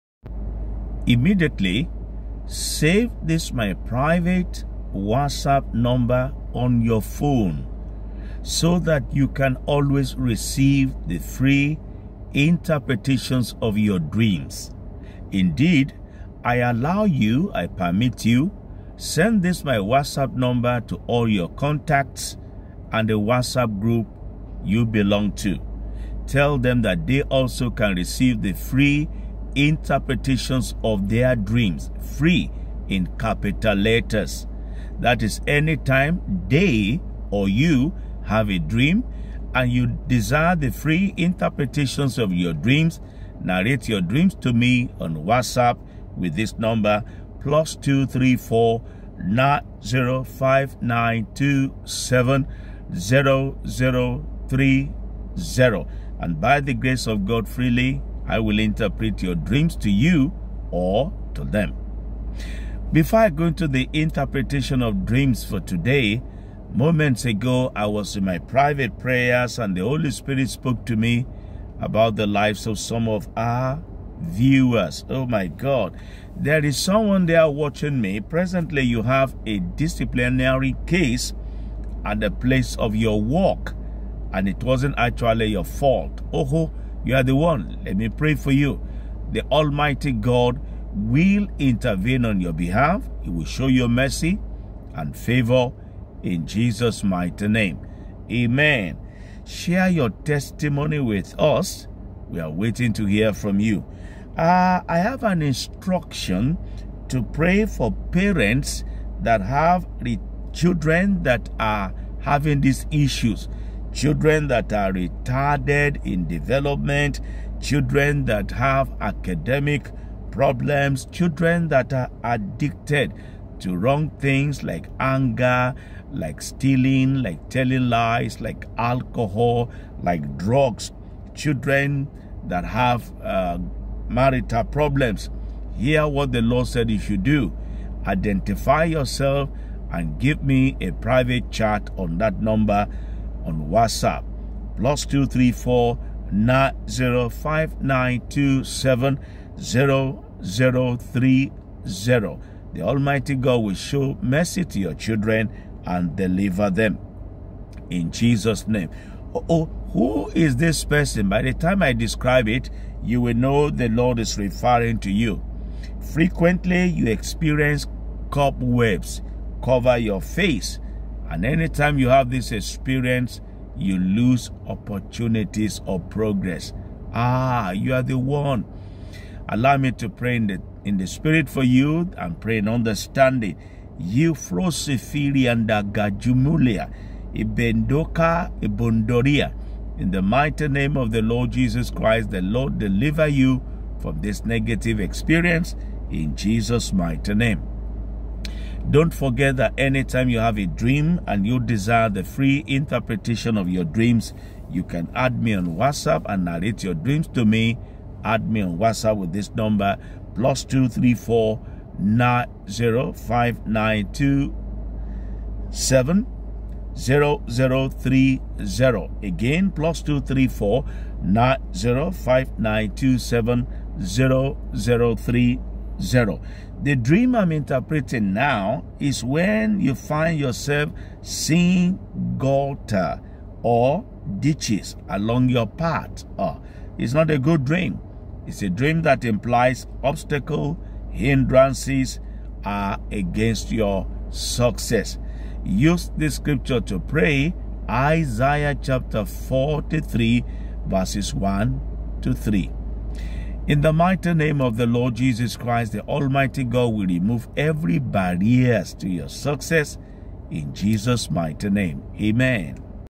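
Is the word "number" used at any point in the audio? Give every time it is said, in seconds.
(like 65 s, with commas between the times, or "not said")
5 s, 20 s, 46 s, 142 s, 209 s.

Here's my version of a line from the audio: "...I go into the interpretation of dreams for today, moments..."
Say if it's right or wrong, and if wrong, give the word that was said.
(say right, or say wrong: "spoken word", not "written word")
right.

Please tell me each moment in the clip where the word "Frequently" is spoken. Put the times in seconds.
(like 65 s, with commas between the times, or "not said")
166 s.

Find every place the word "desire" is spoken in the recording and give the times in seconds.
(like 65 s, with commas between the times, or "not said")
40 s, 201 s.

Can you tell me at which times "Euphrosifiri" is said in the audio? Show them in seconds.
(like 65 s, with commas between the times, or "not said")
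183 s.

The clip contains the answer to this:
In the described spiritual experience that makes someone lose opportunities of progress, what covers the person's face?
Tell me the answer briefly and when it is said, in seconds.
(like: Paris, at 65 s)
Cobwebs, at 168 s.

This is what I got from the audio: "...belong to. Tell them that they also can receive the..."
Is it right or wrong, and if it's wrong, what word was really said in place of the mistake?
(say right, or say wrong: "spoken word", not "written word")
right.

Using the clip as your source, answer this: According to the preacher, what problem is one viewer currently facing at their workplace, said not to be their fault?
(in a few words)
A disciplinary case.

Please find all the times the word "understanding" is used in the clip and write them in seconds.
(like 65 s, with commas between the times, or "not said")
182 s.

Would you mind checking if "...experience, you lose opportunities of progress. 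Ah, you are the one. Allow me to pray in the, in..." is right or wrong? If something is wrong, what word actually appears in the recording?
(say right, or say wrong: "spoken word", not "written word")
right.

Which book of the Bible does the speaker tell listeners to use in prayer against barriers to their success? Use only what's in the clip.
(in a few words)
Isaiah.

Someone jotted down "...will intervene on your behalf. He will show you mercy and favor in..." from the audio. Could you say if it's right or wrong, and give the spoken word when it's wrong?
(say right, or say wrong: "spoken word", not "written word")
right.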